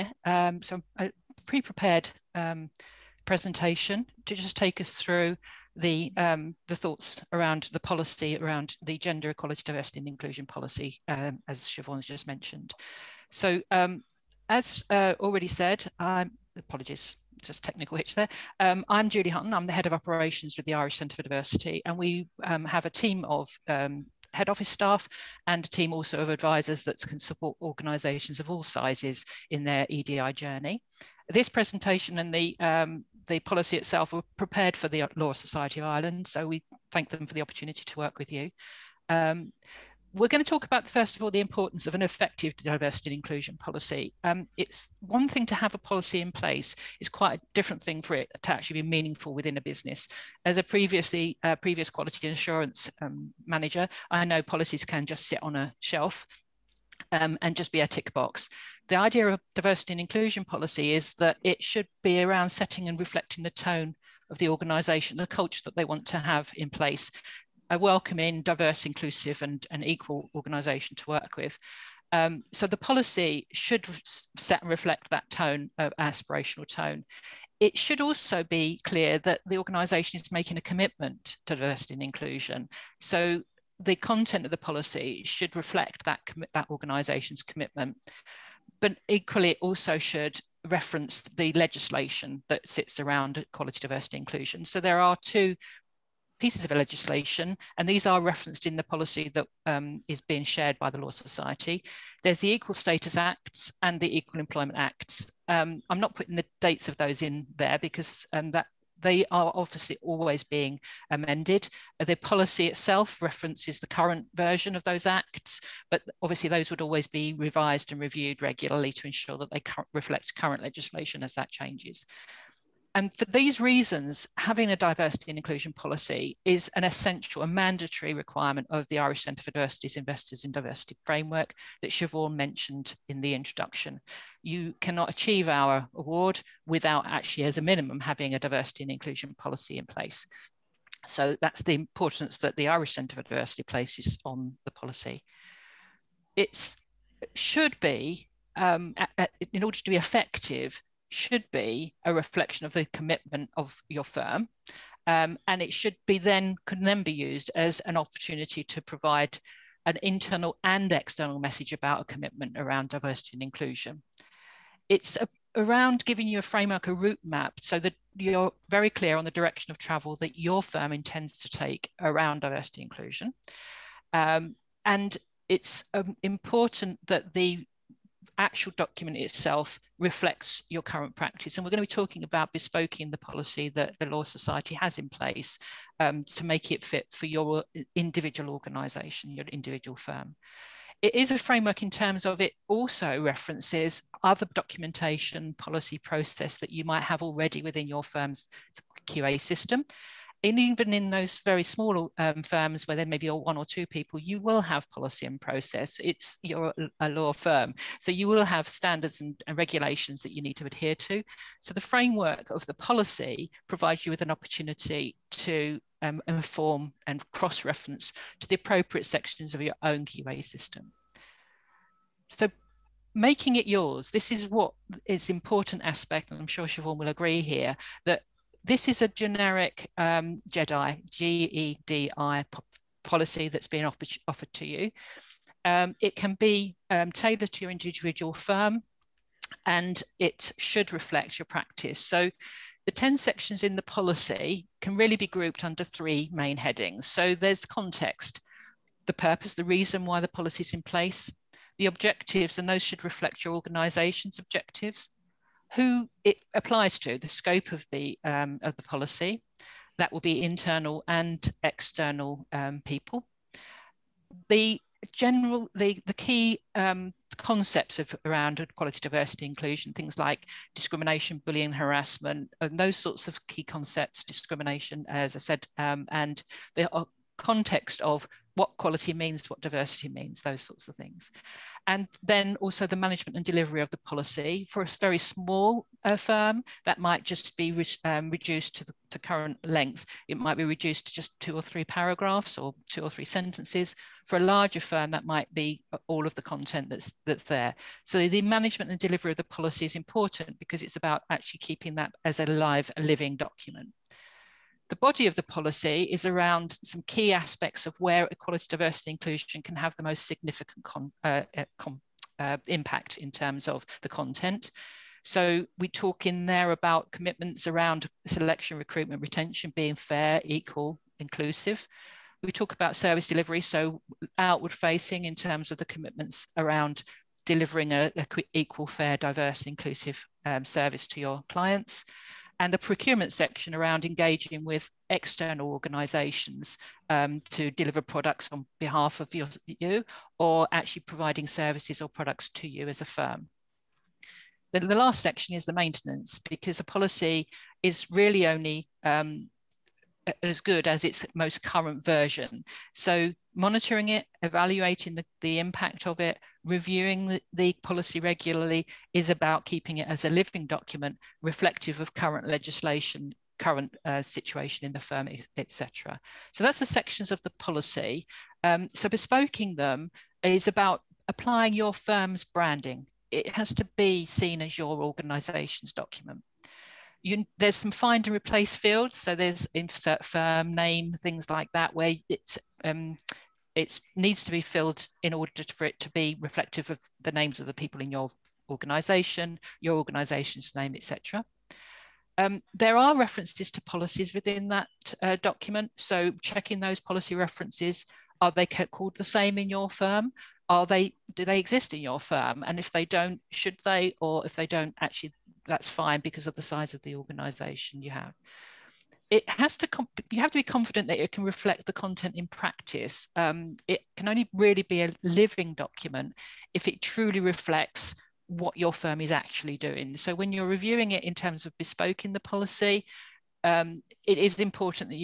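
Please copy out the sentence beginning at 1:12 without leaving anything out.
Um, so the policy should set and reflect that tone, of uh, aspirational tone.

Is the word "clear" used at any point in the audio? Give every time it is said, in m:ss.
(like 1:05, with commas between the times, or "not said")
1:18, 2:48.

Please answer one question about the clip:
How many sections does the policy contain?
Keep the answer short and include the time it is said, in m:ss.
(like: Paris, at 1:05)
10, at 4:02.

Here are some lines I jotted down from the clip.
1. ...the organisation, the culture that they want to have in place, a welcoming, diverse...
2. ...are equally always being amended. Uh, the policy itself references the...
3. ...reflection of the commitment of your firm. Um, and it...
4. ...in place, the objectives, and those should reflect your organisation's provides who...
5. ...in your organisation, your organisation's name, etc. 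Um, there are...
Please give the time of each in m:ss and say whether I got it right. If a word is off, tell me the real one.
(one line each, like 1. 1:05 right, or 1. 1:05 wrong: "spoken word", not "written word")
1. 1:04 right
2. 1:49 wrong: "obviously", not "equally"
3. 2:32 right
4. 4:10 wrong: "objectives", not "provides"
5. 6:28 right.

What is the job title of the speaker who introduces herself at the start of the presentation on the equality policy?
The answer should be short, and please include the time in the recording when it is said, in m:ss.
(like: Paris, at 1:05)
Head of operations, at 0:19.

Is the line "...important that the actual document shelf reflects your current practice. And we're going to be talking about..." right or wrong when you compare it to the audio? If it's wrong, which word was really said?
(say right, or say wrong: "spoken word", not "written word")
wrong: "itself", not "shelf".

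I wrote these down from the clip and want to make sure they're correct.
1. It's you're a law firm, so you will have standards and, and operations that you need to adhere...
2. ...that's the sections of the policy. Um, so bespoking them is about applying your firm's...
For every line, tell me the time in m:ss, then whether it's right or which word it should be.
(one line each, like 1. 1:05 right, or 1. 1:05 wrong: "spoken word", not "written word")
1. 3:26 wrong: "regulations", not "operations"
2. 6:06 right.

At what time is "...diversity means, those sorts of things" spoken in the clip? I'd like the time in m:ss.
4:39.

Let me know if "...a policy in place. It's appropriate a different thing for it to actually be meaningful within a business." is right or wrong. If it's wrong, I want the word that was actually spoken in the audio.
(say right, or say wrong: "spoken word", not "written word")
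wrong: "quite", not "appropriate".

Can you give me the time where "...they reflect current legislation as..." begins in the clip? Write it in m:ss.
1:59.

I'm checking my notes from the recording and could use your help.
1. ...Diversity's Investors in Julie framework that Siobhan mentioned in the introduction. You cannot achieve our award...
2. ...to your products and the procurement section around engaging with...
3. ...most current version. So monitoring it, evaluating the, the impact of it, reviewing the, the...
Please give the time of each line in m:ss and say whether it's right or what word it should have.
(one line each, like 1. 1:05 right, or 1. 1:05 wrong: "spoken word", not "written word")
1. 2:09 wrong: "Diversity", not "Julie"
2. 5:31 wrong: "clients", not "products"
3. 5:51 right.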